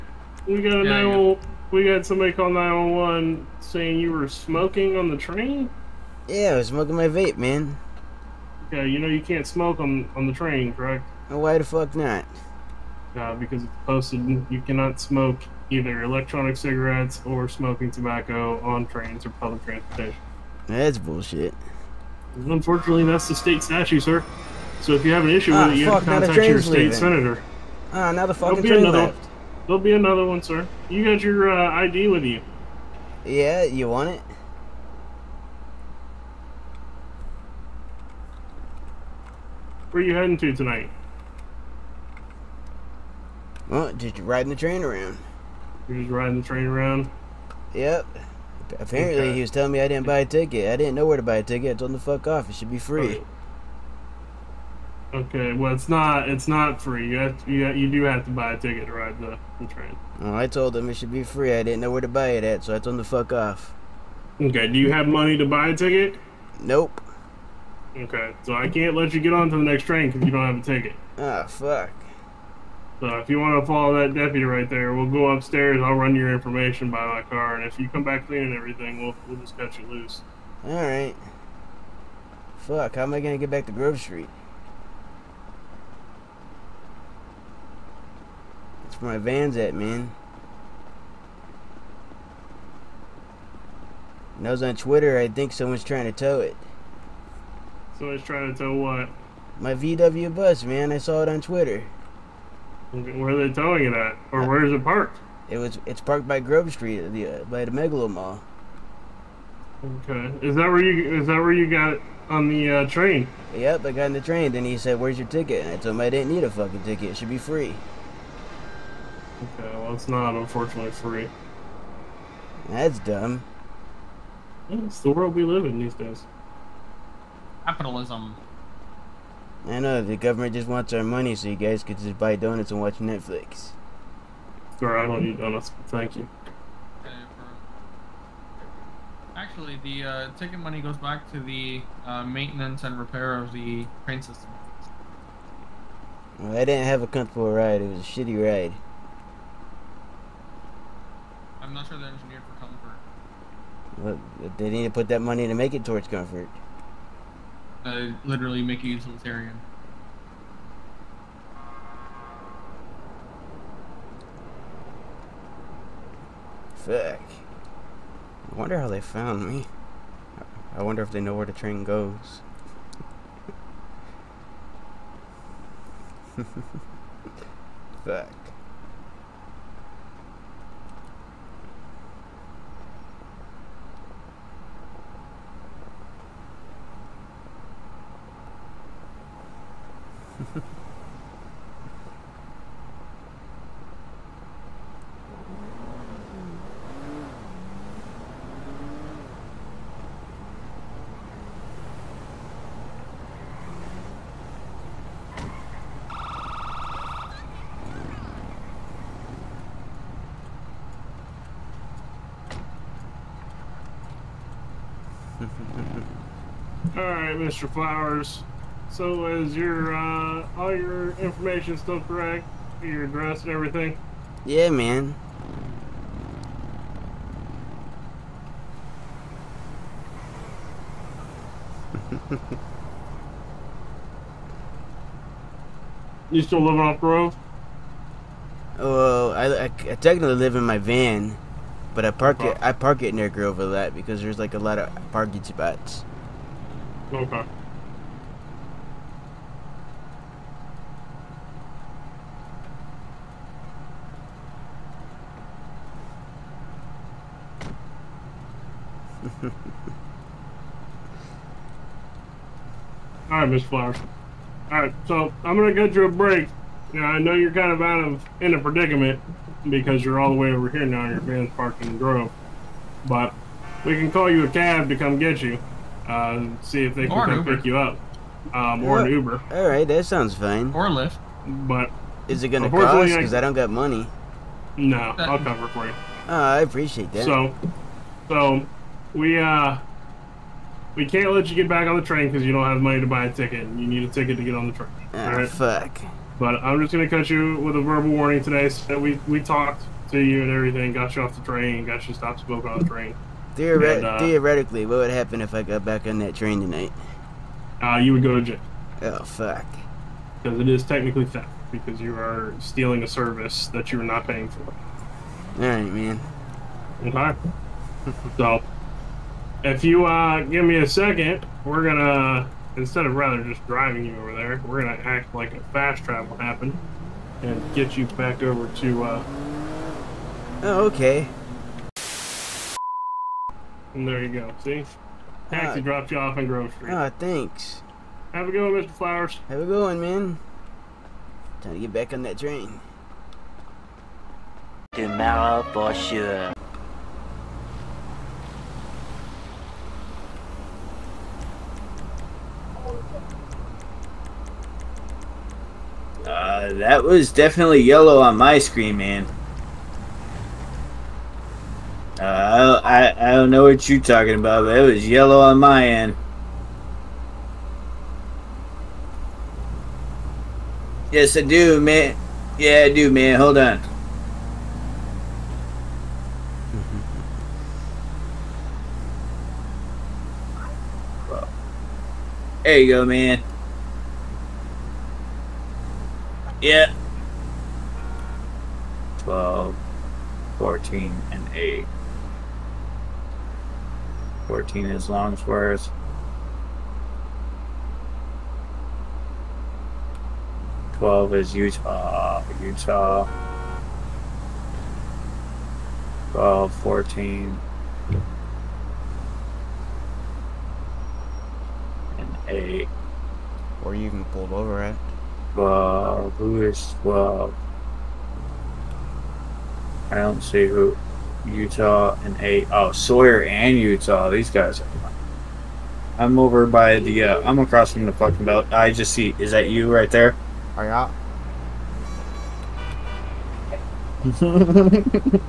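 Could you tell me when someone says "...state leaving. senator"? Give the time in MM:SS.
00:26.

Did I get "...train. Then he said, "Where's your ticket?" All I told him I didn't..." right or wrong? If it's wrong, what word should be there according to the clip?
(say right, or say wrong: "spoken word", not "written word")
wrong: "And", not "All".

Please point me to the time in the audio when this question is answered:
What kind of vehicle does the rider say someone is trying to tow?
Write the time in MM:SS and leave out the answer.
01:39.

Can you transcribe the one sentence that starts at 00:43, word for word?
Well, just riding the train around.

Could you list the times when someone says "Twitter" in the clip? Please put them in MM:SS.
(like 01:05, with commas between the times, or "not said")
01:34, 01:41.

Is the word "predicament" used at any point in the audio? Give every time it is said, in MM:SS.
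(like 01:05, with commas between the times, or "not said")
04:28.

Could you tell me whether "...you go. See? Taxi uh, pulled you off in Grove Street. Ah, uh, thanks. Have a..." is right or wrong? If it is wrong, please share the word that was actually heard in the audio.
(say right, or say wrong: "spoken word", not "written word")
wrong: "dropped", not "pulled".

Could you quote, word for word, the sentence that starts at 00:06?
Yeah, I was smoking my vape, man.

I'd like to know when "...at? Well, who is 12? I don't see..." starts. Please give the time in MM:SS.
06:54.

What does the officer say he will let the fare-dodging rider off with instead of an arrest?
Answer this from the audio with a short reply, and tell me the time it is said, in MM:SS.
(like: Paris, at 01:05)
Verbal warning, at 04:57.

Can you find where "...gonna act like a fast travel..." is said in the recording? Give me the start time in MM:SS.
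05:24.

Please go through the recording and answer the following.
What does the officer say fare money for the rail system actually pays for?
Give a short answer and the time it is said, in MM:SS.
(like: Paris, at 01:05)
Maintenance and repair, at 02:22.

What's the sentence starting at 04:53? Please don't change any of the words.
You need a ticket to get on the train.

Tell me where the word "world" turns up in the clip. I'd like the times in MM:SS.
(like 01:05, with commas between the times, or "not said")
02:05.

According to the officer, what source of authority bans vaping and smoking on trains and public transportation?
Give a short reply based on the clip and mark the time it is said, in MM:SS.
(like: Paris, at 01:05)
State statute, at 00:23.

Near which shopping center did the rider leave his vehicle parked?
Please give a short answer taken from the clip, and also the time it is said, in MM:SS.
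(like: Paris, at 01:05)
Megalo Mall, at 01:47.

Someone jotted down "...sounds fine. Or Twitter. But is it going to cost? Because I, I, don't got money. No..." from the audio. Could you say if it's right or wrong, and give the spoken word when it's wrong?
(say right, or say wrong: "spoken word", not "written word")
wrong: "Lyft", not "Twitter".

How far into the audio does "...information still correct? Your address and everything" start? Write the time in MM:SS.
03:41.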